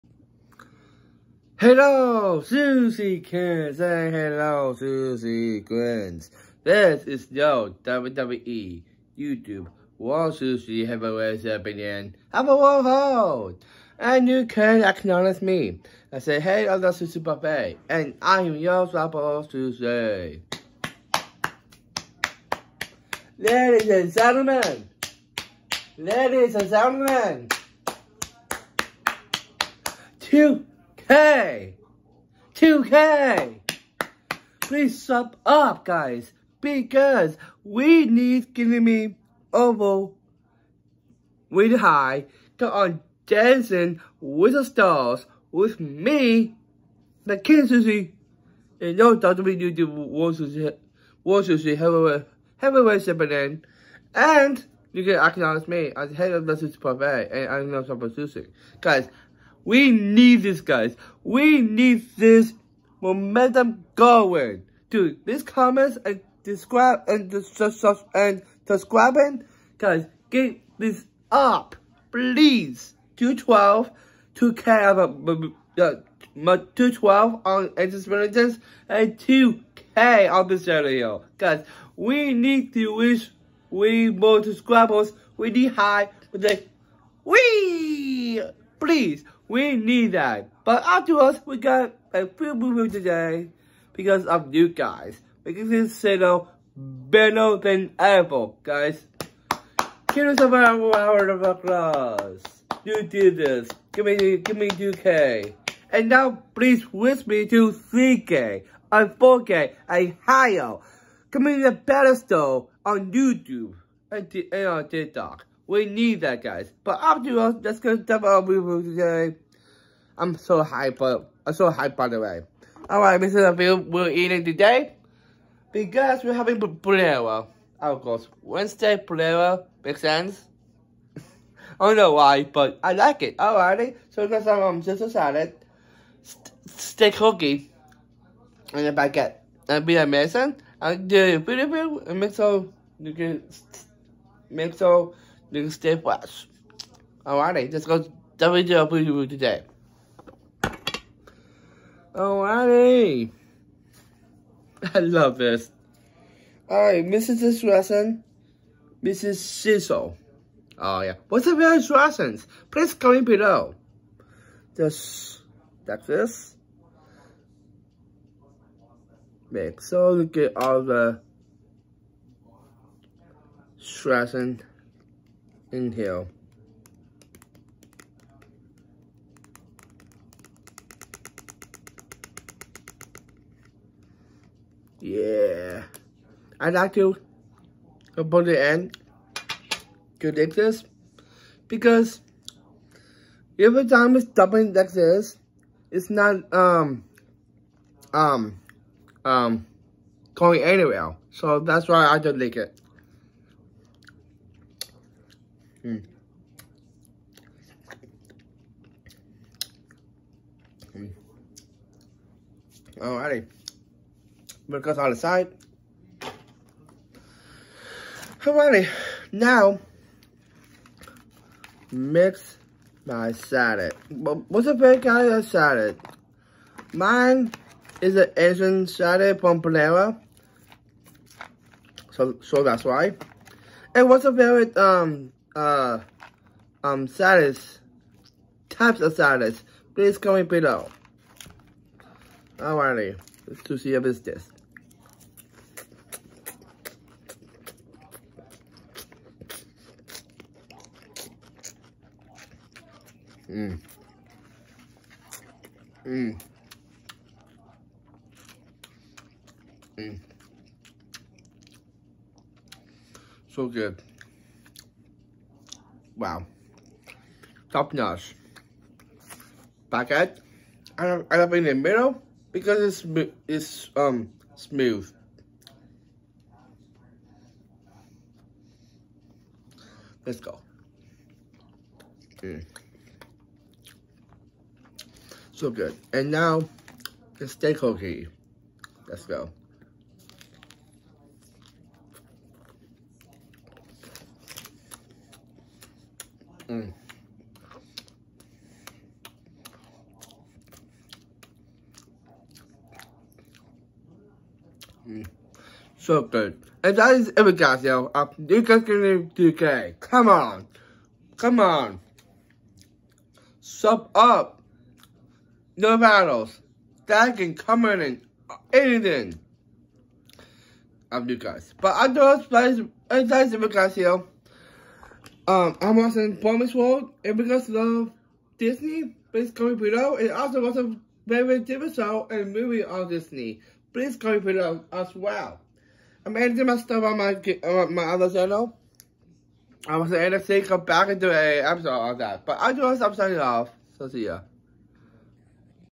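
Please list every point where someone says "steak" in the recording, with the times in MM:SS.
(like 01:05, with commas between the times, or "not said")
02:16, 04:47.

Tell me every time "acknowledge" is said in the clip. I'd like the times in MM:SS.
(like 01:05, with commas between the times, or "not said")
00:14, 00:55.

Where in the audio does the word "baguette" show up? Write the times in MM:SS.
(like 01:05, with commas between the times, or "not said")
02:18, 04:29.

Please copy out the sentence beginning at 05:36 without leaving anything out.
I'm editing my stuff on my on uh, my other channel.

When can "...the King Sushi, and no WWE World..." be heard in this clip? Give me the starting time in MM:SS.
00:47.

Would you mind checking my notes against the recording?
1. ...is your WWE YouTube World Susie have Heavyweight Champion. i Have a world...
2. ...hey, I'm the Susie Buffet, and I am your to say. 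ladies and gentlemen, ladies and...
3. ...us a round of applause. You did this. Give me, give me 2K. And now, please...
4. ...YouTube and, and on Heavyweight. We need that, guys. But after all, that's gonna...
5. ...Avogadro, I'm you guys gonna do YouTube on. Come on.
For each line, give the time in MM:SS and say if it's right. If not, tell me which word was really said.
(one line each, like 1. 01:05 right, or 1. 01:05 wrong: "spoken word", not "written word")
1. 00:07 right
2. 00:16 right
3. 01:40 right
4. 01:53 wrong: "TikTok", not "Heavyweight"
5. 05:07 wrong: "Come", not "YouTube".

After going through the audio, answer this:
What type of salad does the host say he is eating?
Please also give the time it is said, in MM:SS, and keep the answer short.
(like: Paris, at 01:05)
Asian salad, at 03:48.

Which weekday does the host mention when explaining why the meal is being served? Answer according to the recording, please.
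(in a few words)
Wednesday.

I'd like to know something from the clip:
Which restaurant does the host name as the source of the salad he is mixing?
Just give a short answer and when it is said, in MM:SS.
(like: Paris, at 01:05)
Panera, at 03:49.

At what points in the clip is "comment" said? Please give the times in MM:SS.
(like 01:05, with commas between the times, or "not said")
01:05, 02:42, 04:00.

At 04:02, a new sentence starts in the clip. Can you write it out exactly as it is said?
Alrighty, let's to see if it's this.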